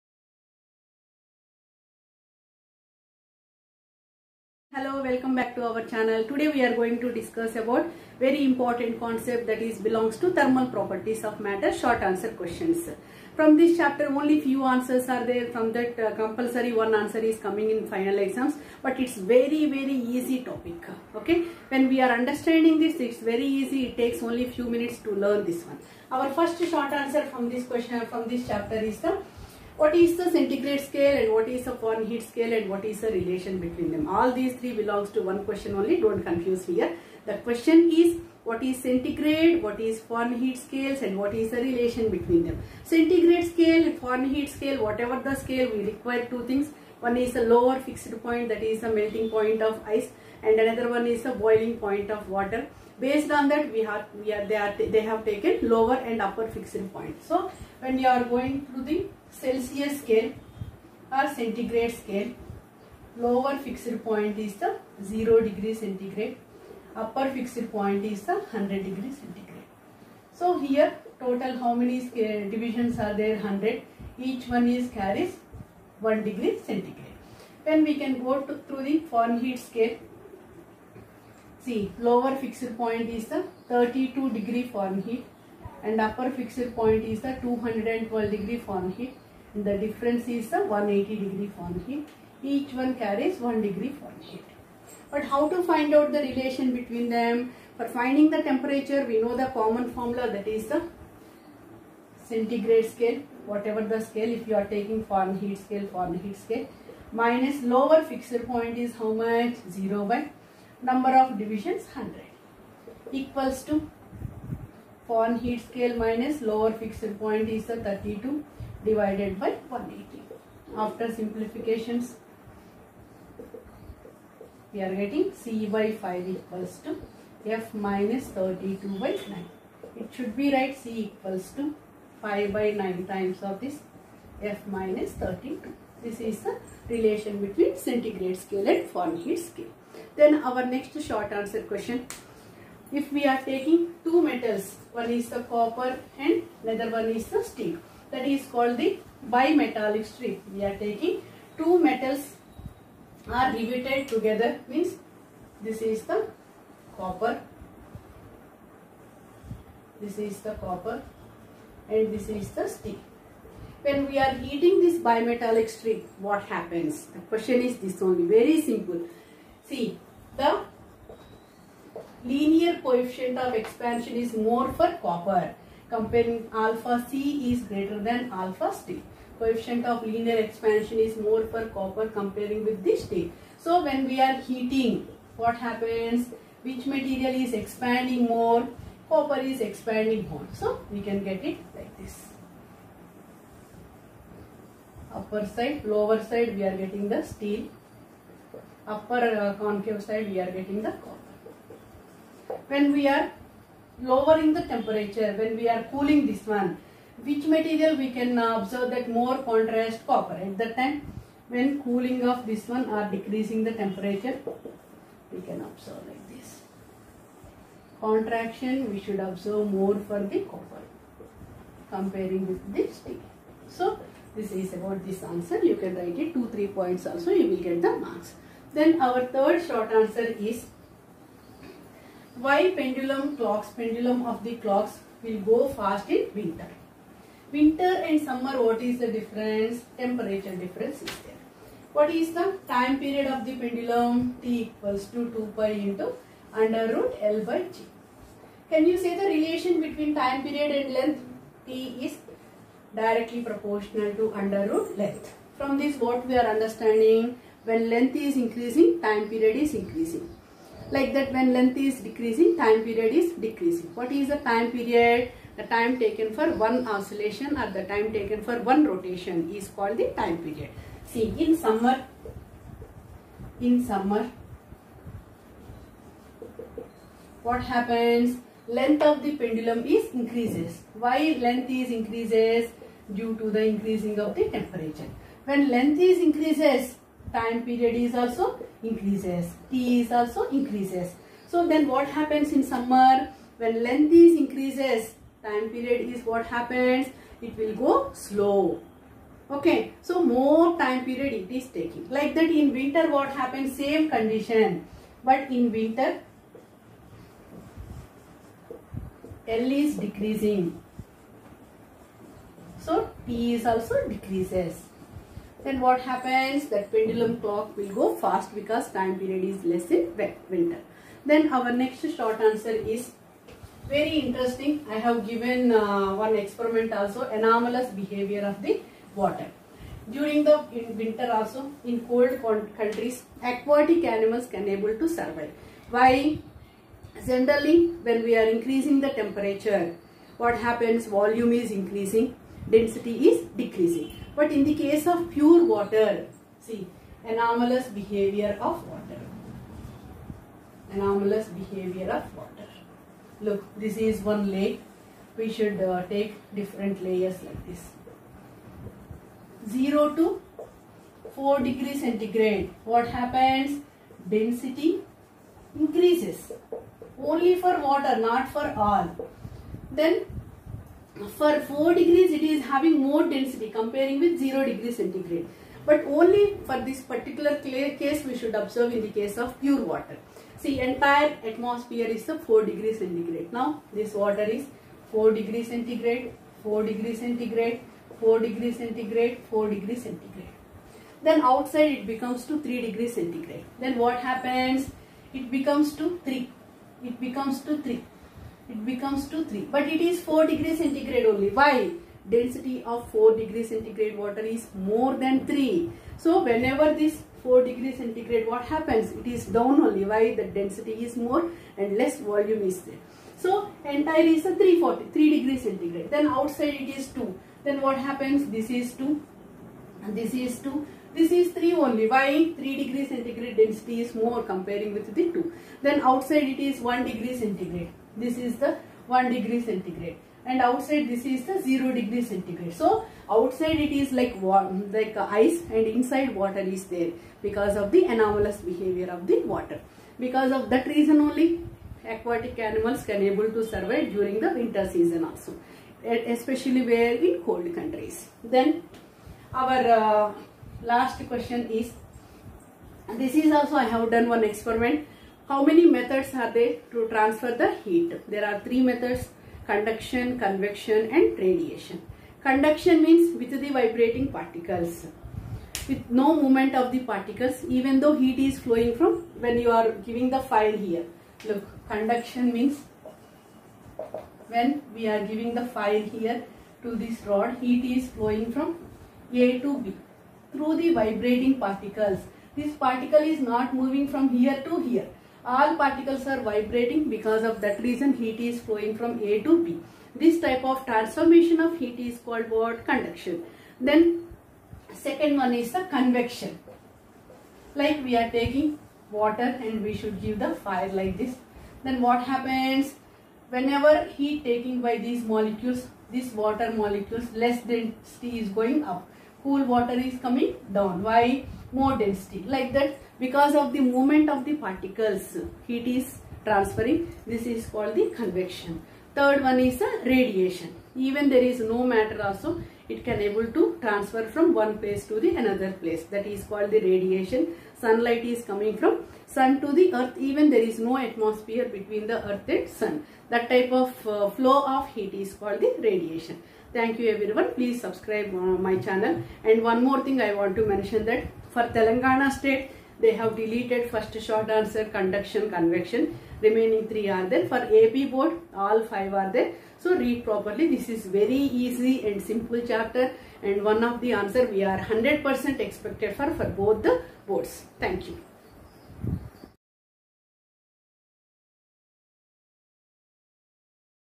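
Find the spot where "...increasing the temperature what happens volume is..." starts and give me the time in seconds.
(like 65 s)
338 s.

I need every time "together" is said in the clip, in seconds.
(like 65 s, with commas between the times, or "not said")
154 s.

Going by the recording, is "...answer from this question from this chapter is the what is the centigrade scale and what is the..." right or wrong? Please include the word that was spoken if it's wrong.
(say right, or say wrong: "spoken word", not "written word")
right.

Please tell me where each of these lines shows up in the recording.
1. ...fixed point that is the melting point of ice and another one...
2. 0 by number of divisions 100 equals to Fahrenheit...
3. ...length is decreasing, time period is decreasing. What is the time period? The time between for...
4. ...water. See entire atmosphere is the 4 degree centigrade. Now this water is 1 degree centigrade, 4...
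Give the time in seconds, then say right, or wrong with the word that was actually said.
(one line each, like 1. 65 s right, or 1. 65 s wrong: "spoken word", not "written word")
1. 47 s right
2. 109 s right
3. 261 s wrong: "taken", not "between"
4. 379 s wrong: "4", not "1".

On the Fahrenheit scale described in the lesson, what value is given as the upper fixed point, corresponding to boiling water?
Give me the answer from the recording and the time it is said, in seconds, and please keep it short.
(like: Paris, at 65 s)
212 degree Fahrenheit, at 87 s.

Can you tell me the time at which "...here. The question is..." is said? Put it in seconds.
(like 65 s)
36 s.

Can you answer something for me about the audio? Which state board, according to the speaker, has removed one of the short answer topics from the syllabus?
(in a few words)
Telangana.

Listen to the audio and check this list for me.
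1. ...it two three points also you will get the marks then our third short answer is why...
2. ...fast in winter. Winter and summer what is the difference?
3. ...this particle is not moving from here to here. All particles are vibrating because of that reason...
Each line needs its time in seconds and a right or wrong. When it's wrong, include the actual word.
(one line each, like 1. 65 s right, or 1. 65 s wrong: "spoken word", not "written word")
1. 226 s right
2. 235 s right
3. 482 s right.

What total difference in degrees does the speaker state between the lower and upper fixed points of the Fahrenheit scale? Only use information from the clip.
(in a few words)
180 degree Fahrenheit.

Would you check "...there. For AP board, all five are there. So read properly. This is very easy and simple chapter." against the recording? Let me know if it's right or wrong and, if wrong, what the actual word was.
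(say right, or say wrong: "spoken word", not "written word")
right.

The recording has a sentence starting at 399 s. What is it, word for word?
But it is 4 degree centigrade only.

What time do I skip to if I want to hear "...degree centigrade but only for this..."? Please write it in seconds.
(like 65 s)
374 s.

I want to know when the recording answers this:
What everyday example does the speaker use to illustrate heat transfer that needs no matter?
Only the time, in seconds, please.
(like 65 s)
527 s.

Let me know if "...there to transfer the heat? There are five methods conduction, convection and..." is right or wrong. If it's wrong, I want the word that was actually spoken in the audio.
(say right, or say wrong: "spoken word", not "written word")
wrong: "three", not "five".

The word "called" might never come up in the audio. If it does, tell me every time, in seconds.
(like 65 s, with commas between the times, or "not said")
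148 s, 269 s, 492 s, 517 s, 526 s, 535 s.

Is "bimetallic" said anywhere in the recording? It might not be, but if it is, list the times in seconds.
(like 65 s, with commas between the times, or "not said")
149 s, 164 s.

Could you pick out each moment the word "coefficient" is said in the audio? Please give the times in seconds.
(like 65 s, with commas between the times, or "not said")
172 s, 179 s.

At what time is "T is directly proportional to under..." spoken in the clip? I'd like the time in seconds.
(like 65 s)
251 s.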